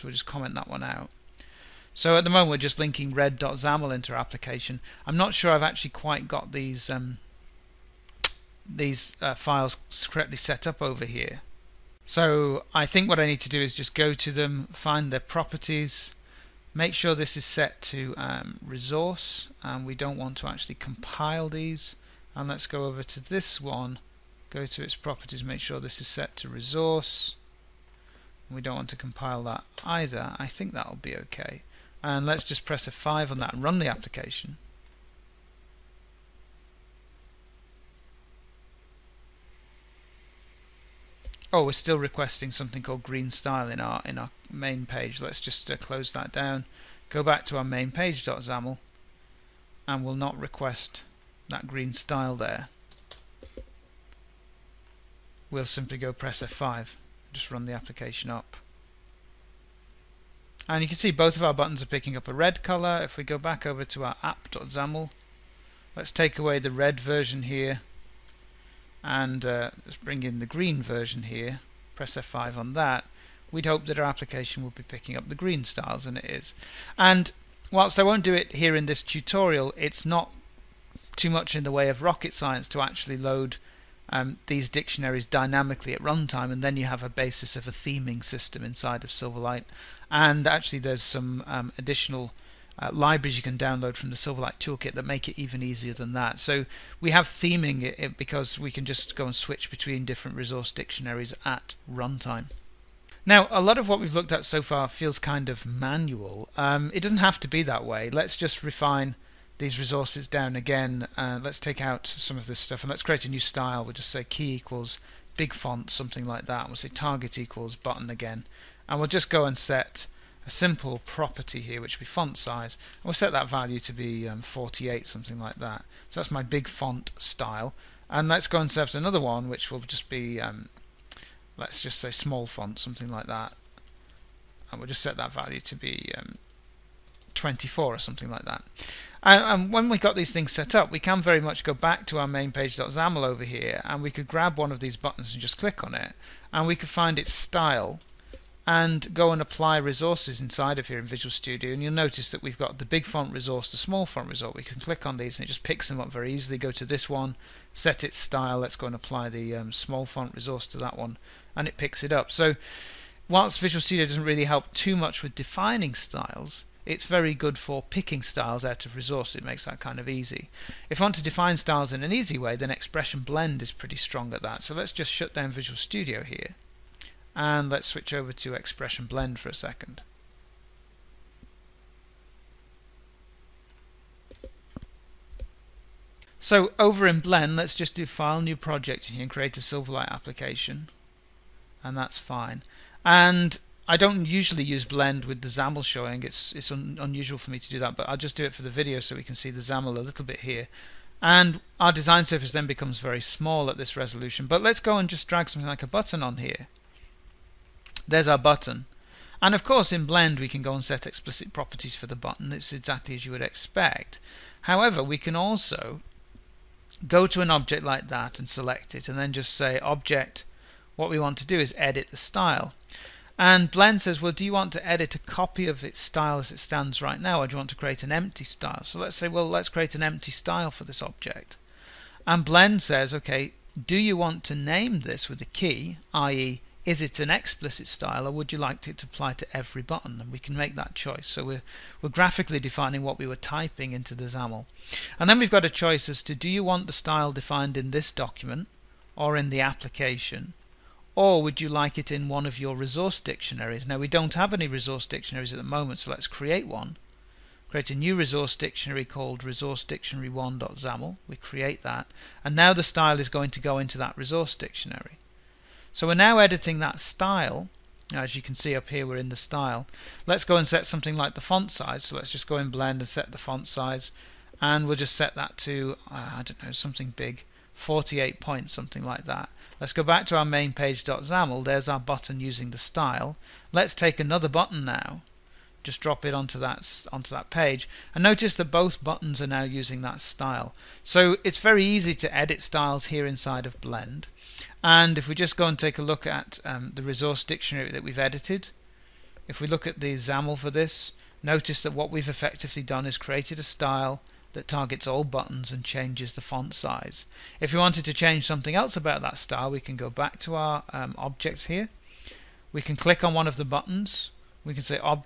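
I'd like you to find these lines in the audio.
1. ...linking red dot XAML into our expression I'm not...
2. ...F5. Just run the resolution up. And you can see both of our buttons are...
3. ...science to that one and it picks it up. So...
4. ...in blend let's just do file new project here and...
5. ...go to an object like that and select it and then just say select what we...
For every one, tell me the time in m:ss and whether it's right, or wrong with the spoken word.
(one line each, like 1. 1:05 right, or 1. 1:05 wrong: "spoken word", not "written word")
1. 0:02 wrong: "application", not "expression"
2. 0:56 wrong: "application", not "resolution"
3. 2:40 wrong: "resource", not "science"
4. 3:07 right
5. 3:37 wrong: "object", not "select".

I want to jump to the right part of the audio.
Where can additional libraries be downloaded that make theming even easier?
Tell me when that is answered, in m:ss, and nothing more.
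1:34.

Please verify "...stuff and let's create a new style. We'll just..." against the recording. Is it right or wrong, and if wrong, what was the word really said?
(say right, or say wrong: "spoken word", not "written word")
right.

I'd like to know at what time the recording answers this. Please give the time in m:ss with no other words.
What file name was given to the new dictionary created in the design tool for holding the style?
4:19.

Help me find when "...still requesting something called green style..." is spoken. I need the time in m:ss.
0:41.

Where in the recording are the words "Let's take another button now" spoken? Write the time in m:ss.
4:43.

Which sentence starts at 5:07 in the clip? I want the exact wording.
If we wanted to change something else about that style, we can go back to our um, objects here.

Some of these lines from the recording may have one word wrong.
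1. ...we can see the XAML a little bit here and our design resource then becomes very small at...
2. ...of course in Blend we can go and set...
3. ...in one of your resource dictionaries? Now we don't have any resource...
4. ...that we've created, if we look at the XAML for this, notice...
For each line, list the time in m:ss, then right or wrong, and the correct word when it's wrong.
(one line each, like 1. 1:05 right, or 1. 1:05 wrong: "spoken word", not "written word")
1. 3:19 wrong: "surface", not "resource"
2. 3:29 right
3. 4:12 right
4. 4:57 wrong: "edited", not "created".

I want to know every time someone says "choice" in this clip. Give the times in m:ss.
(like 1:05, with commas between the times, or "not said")
4:00, 4:05.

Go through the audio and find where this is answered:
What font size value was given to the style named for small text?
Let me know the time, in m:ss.
2:17.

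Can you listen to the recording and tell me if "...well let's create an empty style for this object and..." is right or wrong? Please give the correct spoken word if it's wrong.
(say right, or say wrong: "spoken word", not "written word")
right.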